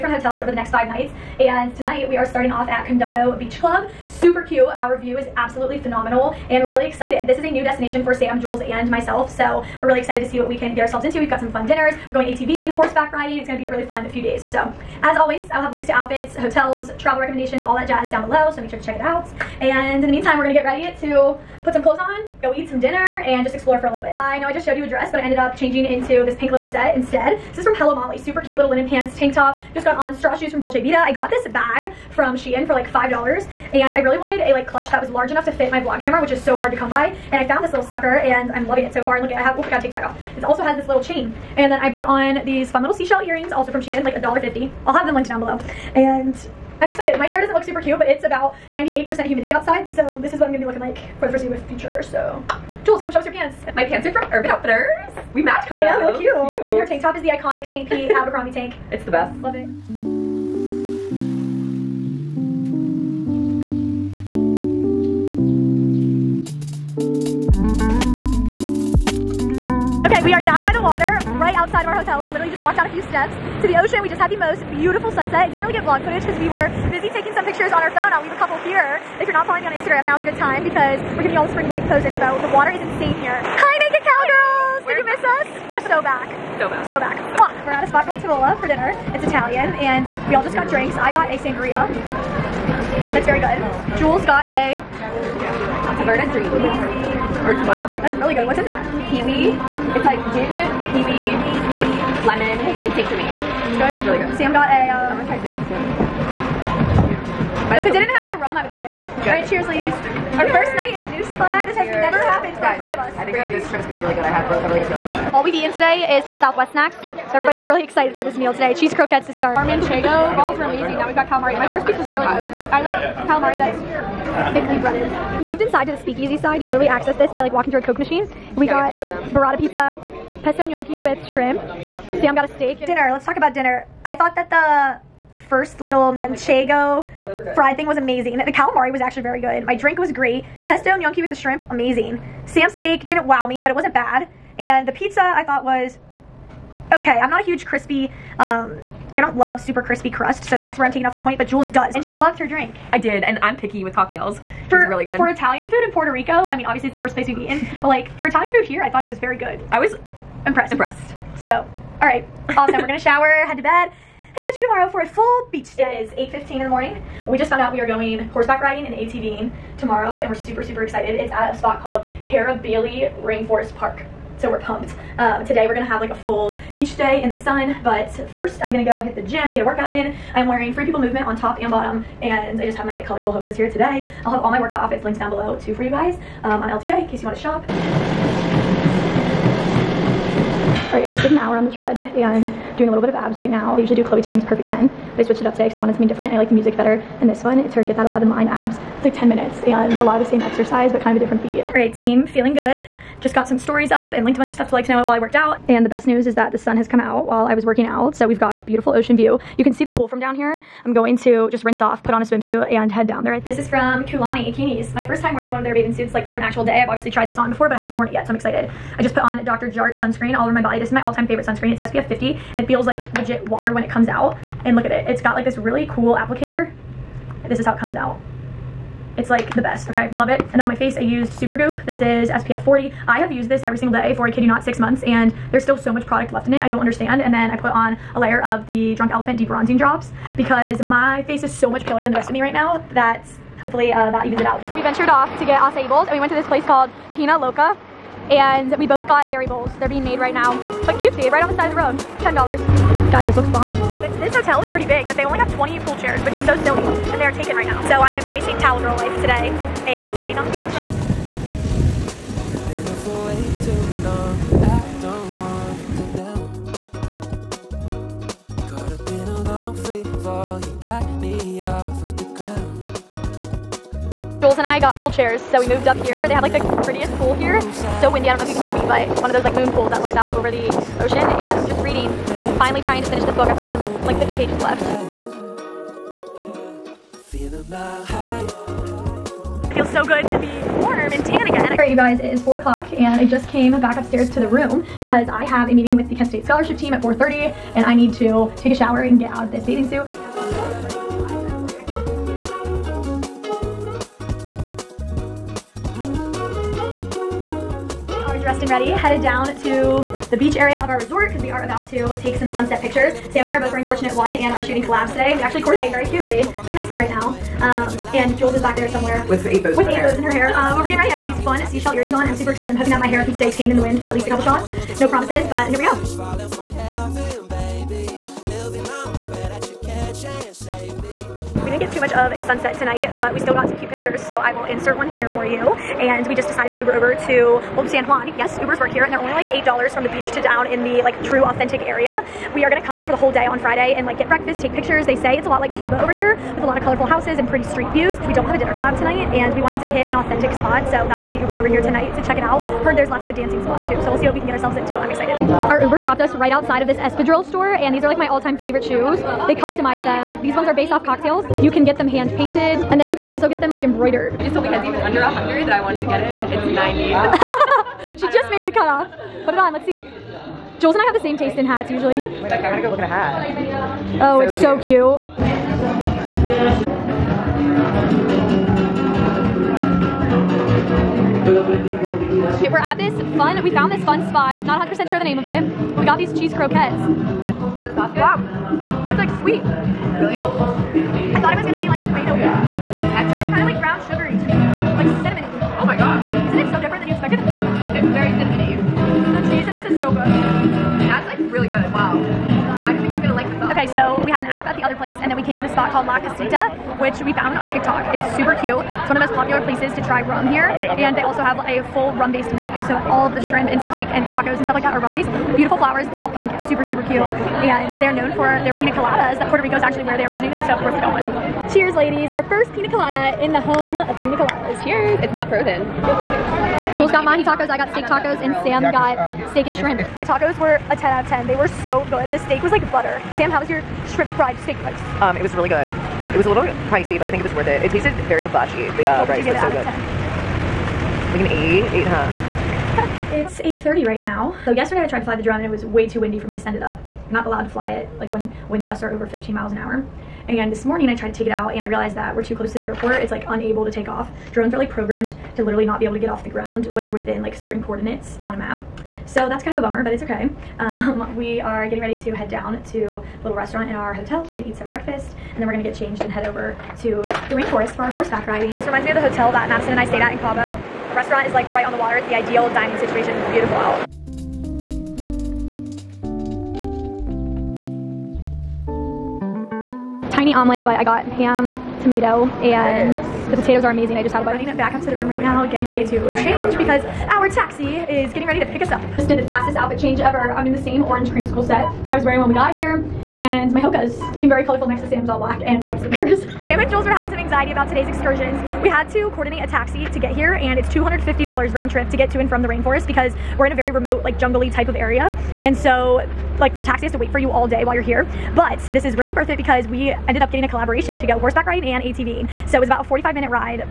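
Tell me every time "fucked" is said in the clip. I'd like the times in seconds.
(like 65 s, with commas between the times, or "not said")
not said.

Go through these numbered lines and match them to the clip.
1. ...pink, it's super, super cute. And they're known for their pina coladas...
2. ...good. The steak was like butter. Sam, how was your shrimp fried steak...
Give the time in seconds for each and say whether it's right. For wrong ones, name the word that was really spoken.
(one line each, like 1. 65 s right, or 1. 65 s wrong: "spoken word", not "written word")
1. 416 s right
2. 432 s right.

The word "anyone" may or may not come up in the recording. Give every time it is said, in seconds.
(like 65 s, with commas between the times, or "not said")
not said.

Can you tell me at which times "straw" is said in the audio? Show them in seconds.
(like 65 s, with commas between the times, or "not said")
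30 s.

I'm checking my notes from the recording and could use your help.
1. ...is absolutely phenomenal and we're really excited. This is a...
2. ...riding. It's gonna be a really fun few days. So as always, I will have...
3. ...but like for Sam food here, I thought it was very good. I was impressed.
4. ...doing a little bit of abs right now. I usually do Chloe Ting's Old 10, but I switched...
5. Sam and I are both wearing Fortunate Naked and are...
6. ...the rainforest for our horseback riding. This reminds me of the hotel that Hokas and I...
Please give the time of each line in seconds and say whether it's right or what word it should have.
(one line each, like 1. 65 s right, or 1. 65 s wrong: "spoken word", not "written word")
1. 5 s right
2. 13 s right
3. 157 s wrong: "Italian", not "Sam"
4. 192 s wrong: "Perfect", not "Old"
5. 313 s wrong: "One", not "Naked"
6. 467 s wrong: "Madison", not "Hokas".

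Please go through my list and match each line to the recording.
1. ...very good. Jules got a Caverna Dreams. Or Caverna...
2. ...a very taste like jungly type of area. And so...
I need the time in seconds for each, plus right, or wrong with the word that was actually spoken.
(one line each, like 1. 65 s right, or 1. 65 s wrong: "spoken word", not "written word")
1. 93 s right
2. 503 s wrong: "remote", not "taste".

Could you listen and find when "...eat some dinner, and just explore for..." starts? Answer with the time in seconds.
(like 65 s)
22 s.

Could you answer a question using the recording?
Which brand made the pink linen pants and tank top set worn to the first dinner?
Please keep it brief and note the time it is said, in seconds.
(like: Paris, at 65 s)
Hello Molly, at 27 s.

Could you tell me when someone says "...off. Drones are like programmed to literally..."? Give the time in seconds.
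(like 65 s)
454 s.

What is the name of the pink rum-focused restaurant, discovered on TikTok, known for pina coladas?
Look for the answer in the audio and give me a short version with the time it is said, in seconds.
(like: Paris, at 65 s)
La Casita, at 406 s.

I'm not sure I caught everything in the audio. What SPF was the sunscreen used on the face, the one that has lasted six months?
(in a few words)
40.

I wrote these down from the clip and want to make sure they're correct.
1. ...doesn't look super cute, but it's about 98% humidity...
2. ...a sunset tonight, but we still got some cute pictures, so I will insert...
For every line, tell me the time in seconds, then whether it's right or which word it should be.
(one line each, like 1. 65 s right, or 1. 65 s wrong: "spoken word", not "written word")
1. 47 s right
2. 332 s right.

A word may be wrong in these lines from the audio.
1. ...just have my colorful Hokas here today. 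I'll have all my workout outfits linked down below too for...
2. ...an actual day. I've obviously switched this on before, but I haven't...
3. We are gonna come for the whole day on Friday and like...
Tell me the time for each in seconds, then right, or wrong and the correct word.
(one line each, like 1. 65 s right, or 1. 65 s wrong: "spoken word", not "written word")
1. 182 s right
2. 216 s wrong: "tried", not "switched"
3. 342 s right.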